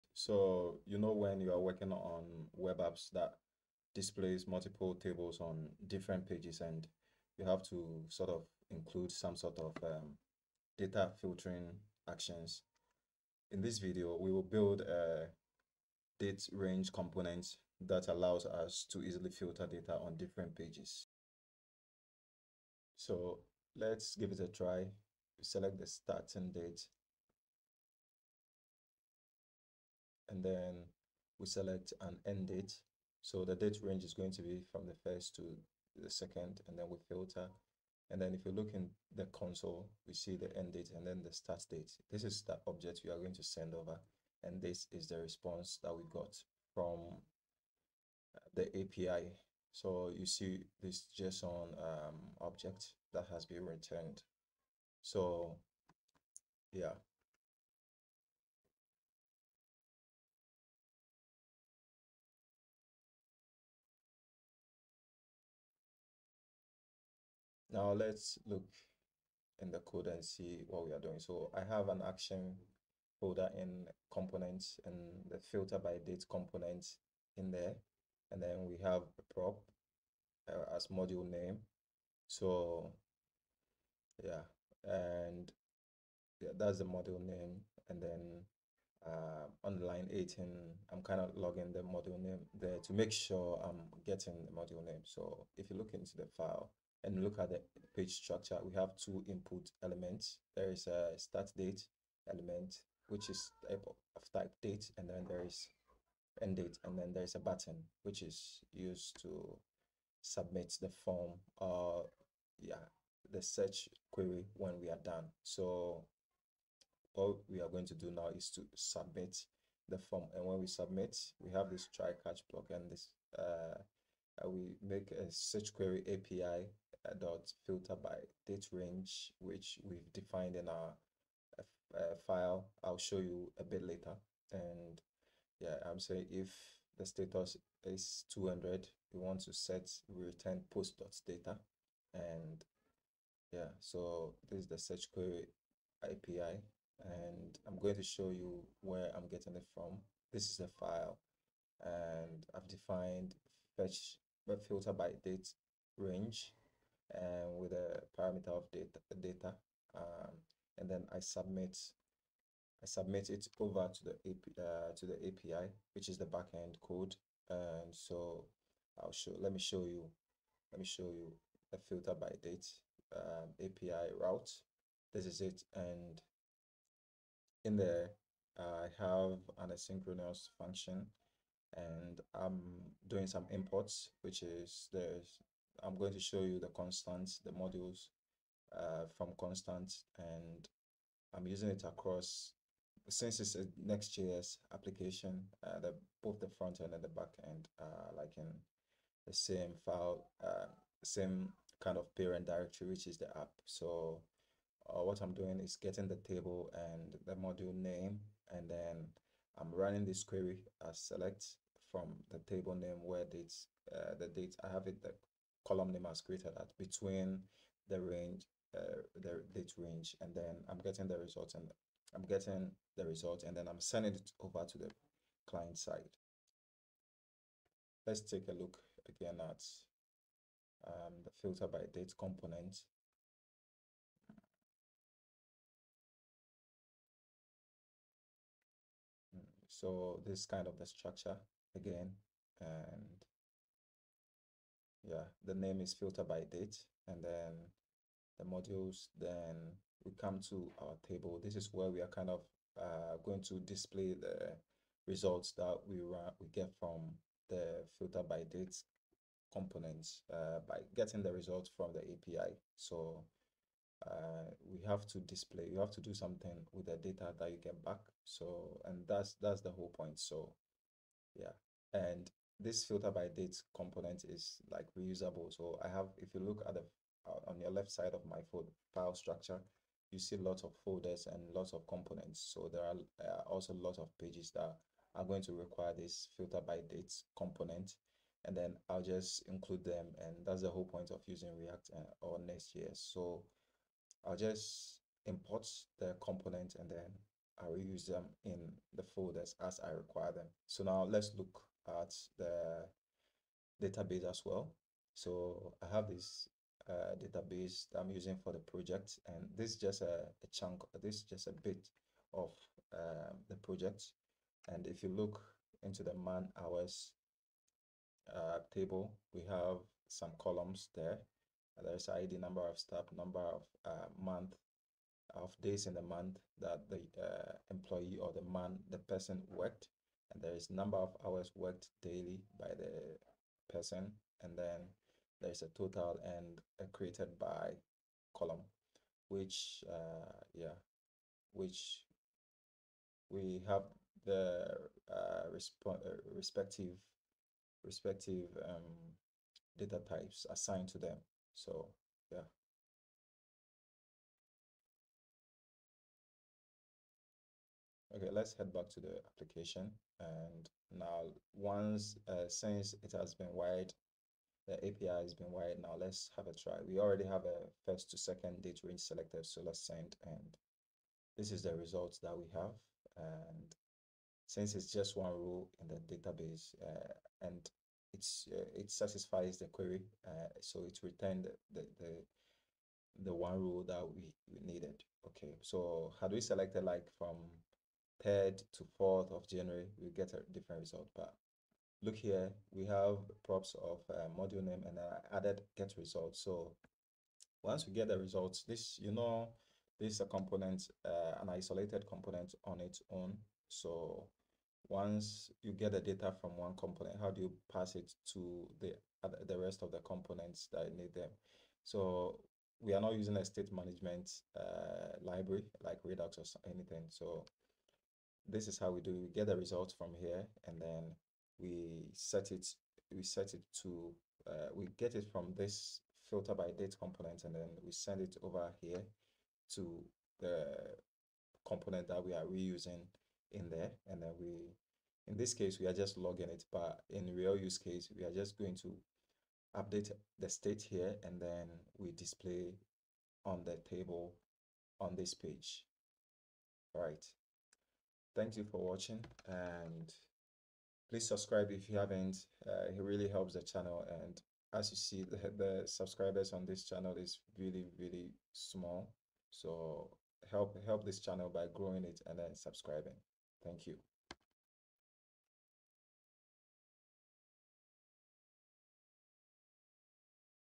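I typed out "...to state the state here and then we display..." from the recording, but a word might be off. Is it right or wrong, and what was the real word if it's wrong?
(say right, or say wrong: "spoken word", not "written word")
wrong: "update", not "state".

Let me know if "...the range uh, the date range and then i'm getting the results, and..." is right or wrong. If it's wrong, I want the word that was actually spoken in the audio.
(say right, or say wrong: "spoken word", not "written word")
right.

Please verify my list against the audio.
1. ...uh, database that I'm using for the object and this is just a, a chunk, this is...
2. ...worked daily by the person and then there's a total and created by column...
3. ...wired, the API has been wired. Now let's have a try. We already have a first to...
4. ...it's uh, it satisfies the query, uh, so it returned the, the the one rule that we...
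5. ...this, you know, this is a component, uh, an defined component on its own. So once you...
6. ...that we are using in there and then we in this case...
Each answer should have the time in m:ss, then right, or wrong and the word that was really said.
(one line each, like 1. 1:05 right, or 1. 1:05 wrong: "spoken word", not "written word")
1. 5:06 wrong: "project", not "object"
2. 5:31 right
3. 6:03 right
4. 6:18 right
5. 6:38 wrong: "isolated", not "defined"
6. 7:12 wrong: "reusing", not "using".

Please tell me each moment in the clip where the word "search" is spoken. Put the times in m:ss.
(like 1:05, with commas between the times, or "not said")
1:53, 2:05, 2:24.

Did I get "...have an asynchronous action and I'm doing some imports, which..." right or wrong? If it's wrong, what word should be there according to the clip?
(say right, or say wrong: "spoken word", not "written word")
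wrong: "function", not "action".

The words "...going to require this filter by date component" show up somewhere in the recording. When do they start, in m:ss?
4:45.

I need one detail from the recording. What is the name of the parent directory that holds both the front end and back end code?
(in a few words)
app.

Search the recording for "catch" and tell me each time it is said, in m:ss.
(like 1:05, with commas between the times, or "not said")
2:02.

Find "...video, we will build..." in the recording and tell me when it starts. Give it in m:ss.
0:13.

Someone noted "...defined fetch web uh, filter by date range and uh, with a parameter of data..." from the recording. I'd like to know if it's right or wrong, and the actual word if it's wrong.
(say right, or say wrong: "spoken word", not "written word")
right.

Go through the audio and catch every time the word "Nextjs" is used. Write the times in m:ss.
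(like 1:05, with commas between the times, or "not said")
3:13, 4:52.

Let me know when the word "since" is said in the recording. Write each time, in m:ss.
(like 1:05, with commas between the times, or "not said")
3:13, 6:02, 6:14.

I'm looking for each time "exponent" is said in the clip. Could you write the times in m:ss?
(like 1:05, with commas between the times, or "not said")
not said.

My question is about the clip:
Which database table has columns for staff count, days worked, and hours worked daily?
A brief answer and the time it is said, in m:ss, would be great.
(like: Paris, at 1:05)
man hours, at 5:16.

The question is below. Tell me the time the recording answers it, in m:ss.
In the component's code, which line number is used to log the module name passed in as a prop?
1:29.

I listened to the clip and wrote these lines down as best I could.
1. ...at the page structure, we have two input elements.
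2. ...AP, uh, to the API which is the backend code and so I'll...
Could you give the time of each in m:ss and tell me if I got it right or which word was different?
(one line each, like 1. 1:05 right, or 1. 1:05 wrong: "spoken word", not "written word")
1. 1:37 right
2. 2:44 right.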